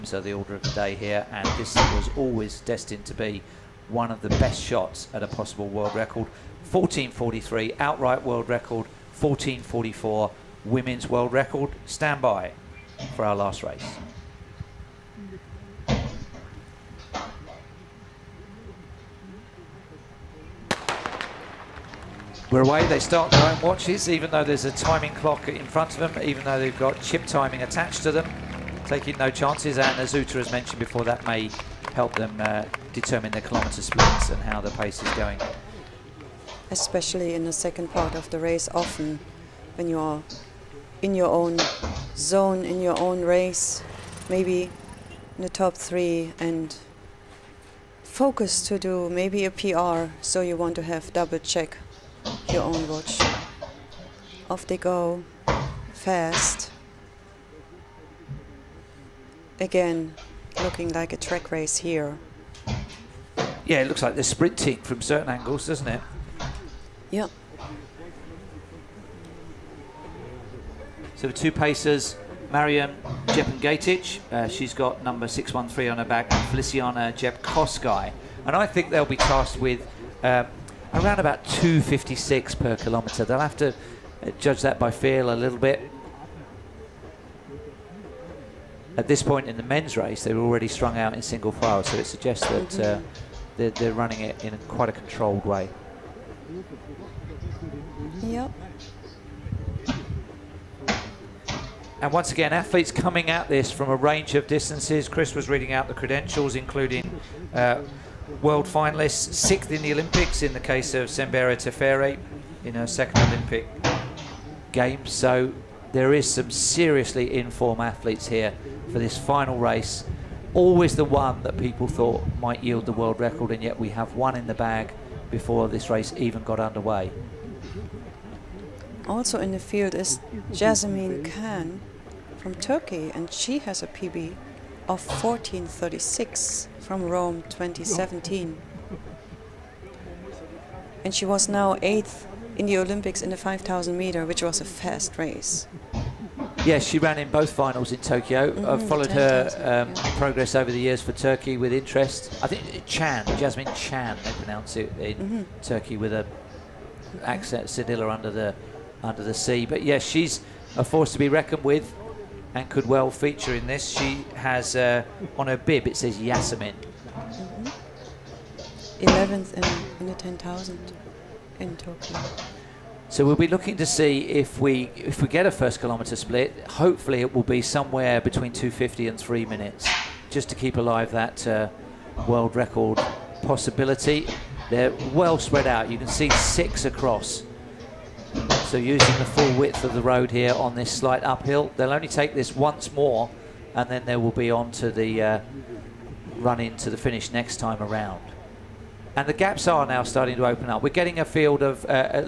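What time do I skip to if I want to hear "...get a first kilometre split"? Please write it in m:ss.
2:55.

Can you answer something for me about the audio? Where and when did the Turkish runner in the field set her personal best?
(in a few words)
Rome 2017.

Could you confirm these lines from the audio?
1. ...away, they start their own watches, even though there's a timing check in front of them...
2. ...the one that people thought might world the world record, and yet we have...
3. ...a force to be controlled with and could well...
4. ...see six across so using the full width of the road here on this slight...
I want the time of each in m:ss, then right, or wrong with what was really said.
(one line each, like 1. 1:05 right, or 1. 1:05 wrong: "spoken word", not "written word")
1. 0:22 wrong: "clock", not "check"
2. 2:00 wrong: "yield", not "world"
3. 2:40 wrong: "reckoned", not "controlled"
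4. 3:06 right.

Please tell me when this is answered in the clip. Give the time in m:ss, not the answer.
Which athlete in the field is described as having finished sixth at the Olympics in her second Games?
1:51.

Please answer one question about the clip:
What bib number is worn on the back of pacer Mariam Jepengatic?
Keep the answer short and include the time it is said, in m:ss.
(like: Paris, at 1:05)
613, at 1:15.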